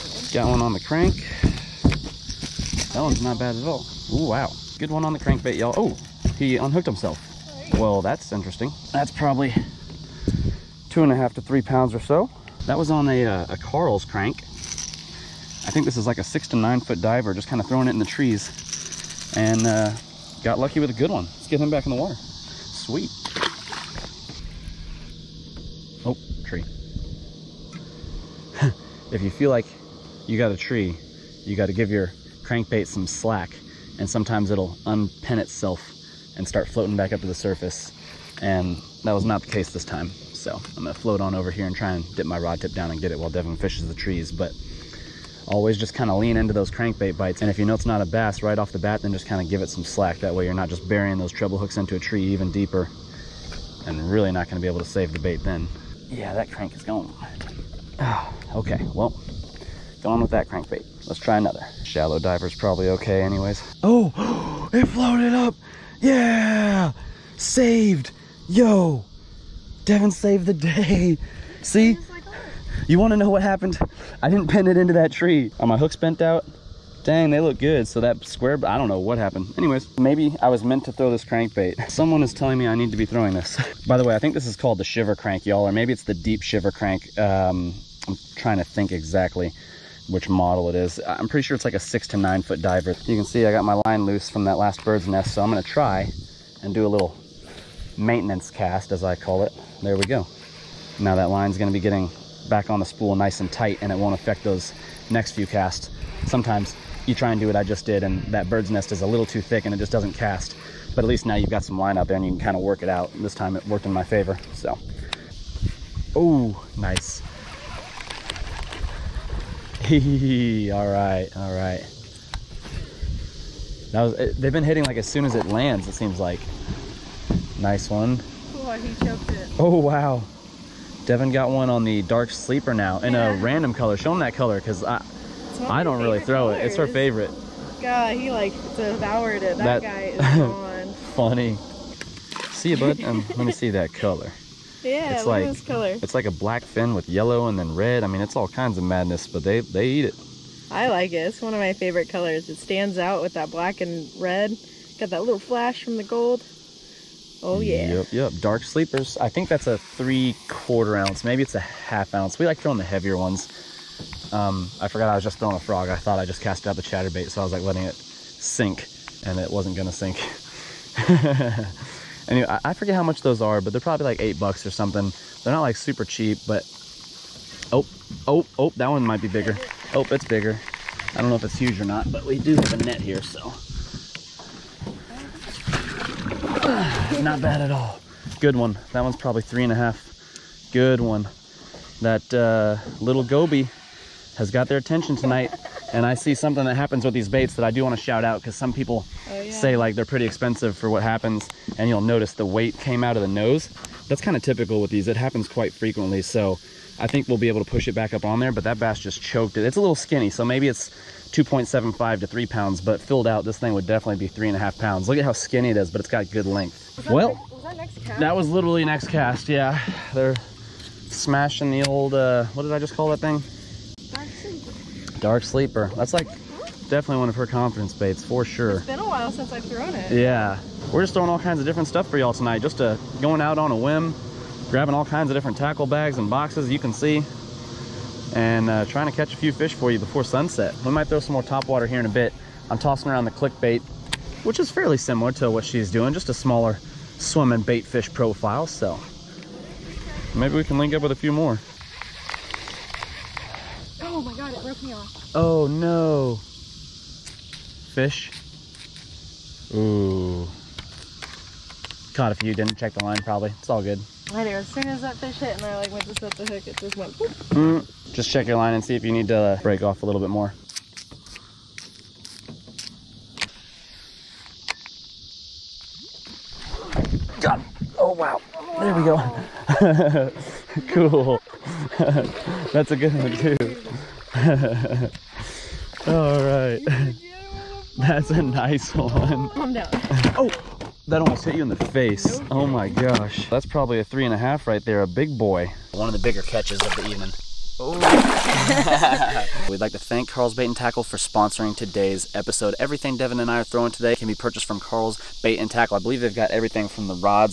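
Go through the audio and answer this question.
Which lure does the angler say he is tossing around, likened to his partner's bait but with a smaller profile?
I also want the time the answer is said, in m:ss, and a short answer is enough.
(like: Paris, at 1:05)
Clickbait, at 4:03.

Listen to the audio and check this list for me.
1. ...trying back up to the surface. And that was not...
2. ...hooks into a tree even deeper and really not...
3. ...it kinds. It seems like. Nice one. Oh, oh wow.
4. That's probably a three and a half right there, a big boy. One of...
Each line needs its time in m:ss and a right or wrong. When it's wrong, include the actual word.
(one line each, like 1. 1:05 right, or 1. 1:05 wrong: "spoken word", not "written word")
1. 0:36 wrong: "floating", not "trying"
2. 0:51 right
3. 2:05 wrong: "lands", not "kinds"
4. 4:53 right.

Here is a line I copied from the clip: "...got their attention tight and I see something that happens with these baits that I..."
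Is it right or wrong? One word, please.
wrong.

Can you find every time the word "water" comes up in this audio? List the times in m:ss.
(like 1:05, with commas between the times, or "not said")
0:22, 4:01.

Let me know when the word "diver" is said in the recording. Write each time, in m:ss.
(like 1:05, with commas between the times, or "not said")
0:17, 1:02, 1:32.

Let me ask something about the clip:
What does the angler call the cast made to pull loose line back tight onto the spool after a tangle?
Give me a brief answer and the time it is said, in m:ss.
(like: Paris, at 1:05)
Maintenance cast, at 1:37.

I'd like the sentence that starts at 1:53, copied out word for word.
This time it worked in my favor, so.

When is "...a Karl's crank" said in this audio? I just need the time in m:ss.
0:13.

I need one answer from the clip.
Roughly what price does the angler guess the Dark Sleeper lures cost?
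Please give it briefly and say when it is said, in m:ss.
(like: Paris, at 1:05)
$8, at 2:54.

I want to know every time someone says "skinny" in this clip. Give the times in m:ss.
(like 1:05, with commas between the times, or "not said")
3:29, 3:35.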